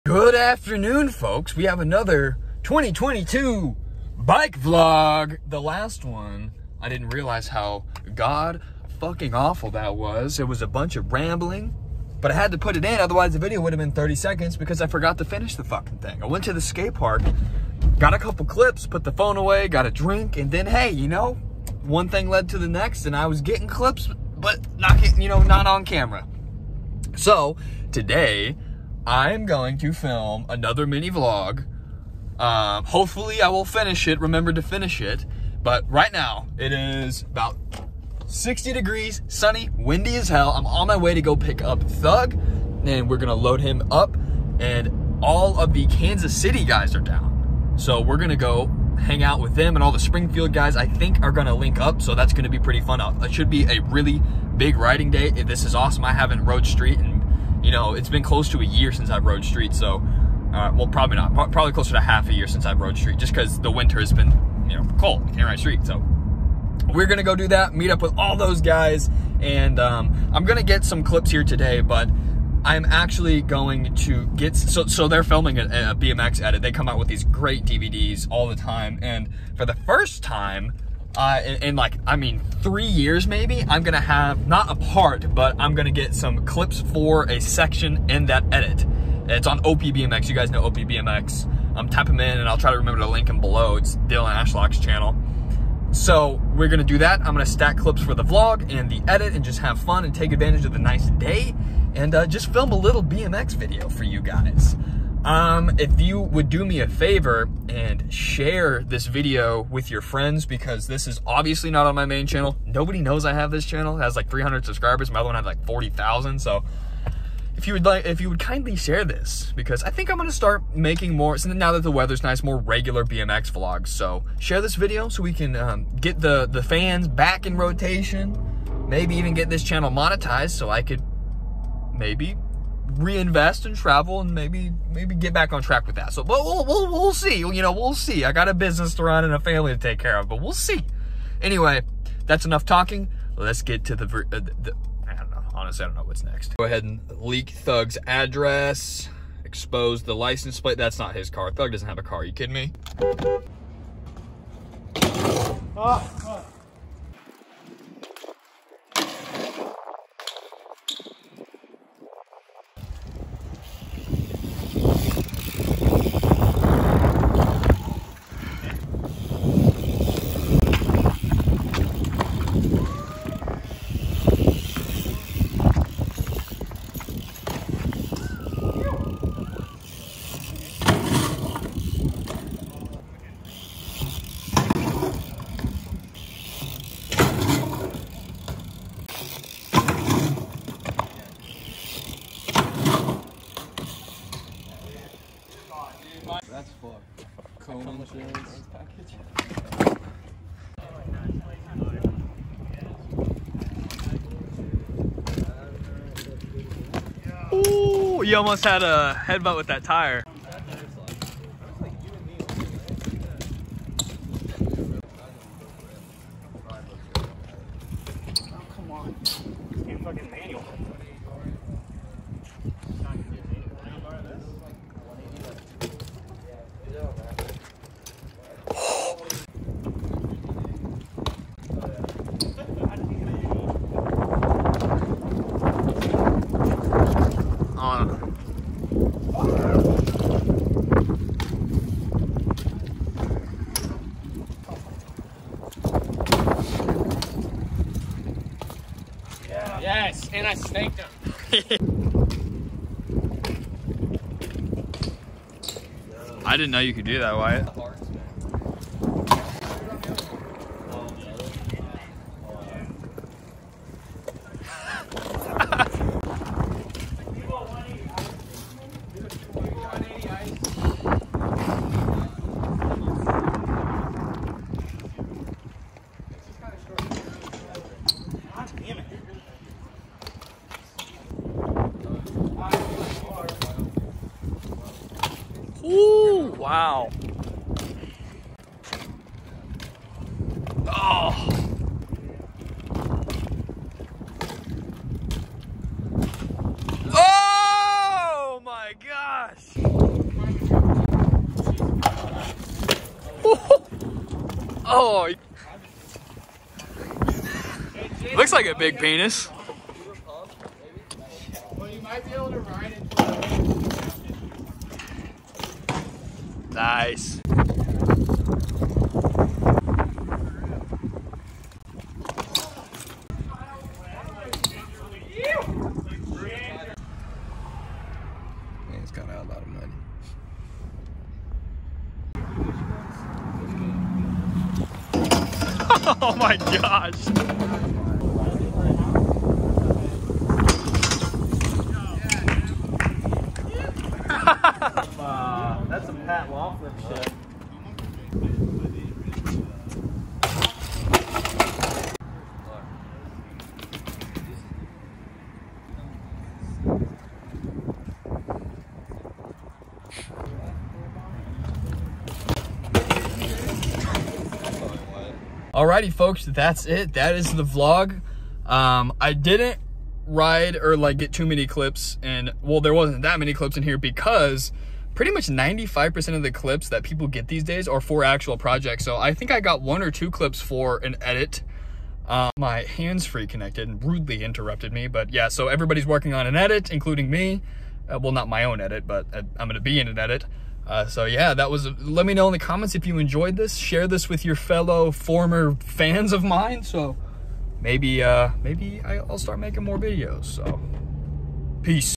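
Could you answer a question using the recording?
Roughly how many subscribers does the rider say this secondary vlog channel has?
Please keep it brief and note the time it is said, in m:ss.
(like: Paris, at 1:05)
300, at 1:54.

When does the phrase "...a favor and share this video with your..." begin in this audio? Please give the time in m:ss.
1:46.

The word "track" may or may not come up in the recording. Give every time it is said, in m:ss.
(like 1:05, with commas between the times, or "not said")
2:15.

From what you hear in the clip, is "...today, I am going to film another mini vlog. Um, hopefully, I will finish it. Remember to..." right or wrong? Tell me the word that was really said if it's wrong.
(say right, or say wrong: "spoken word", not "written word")
right.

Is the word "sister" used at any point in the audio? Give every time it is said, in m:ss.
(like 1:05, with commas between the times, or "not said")
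not said.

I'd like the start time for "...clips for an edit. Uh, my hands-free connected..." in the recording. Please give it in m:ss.
6:20.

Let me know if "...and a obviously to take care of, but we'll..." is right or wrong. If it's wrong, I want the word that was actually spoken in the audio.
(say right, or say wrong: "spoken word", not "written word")
wrong: "family", not "obviously".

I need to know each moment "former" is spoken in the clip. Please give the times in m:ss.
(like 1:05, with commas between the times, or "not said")
6:35.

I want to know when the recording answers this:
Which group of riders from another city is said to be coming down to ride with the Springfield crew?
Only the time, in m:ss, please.
0:45.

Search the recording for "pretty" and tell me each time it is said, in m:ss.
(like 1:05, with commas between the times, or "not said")
0:52, 6:15.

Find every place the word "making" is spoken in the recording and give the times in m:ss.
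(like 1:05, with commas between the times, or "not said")
2:00, 6:39.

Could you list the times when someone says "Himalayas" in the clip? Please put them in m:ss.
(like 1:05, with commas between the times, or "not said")
not said.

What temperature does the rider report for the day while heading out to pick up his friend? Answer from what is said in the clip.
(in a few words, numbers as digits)
60 degrees.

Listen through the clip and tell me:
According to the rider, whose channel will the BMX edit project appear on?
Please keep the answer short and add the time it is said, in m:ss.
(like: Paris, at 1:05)
Dylan Ashlock, at 1:34.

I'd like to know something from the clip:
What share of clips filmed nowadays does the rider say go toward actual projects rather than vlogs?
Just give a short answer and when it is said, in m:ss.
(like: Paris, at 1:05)
95%, at 6:15.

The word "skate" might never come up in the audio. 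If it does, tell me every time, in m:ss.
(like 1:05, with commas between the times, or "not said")
0:16.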